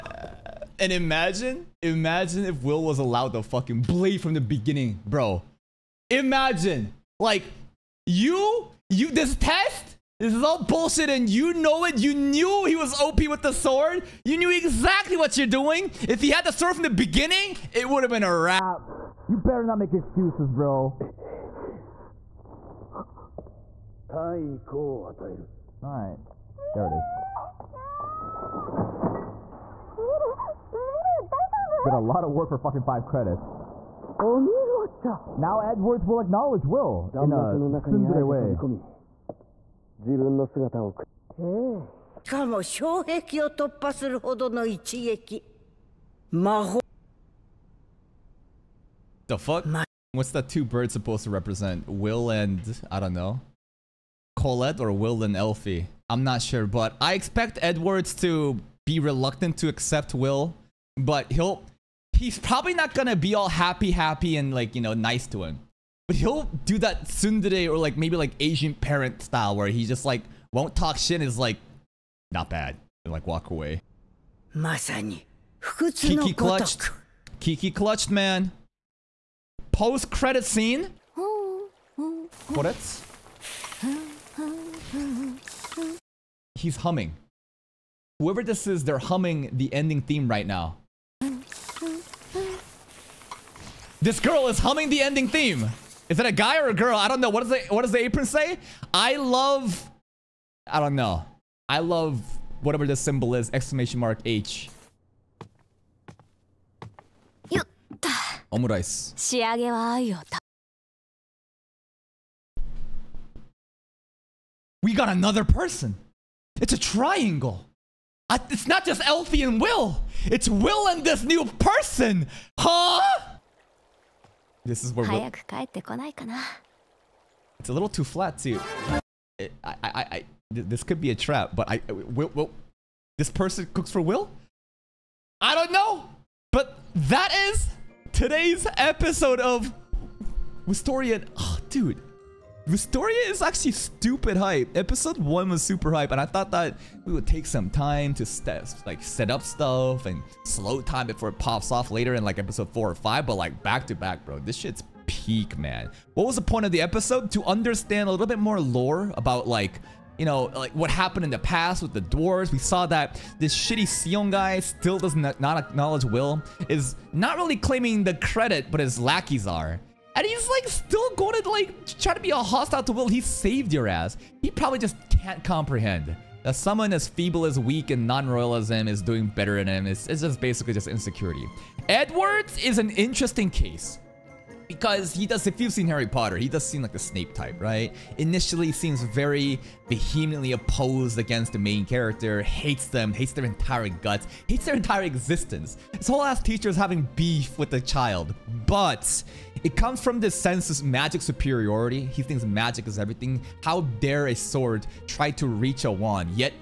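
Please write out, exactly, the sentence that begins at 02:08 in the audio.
I, I, I, this could be a trap, but I, uh, will, will, this person cooks for Will?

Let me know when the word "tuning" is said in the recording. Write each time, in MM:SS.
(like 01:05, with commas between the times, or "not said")
not said.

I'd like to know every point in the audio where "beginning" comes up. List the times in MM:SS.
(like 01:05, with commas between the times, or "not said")
00:04, 00:16.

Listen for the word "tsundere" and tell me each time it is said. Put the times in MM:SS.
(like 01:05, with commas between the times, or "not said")
00:37, 01:07.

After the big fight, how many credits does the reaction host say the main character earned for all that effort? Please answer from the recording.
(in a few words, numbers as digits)
5.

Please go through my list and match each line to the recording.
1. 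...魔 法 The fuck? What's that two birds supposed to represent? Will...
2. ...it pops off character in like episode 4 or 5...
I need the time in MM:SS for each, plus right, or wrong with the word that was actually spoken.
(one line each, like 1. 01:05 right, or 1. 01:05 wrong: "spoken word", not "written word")
1. 00:46 right
2. 02:31 wrong: "later", not "character".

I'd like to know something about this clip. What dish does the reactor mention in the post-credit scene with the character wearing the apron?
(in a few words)
Omurice.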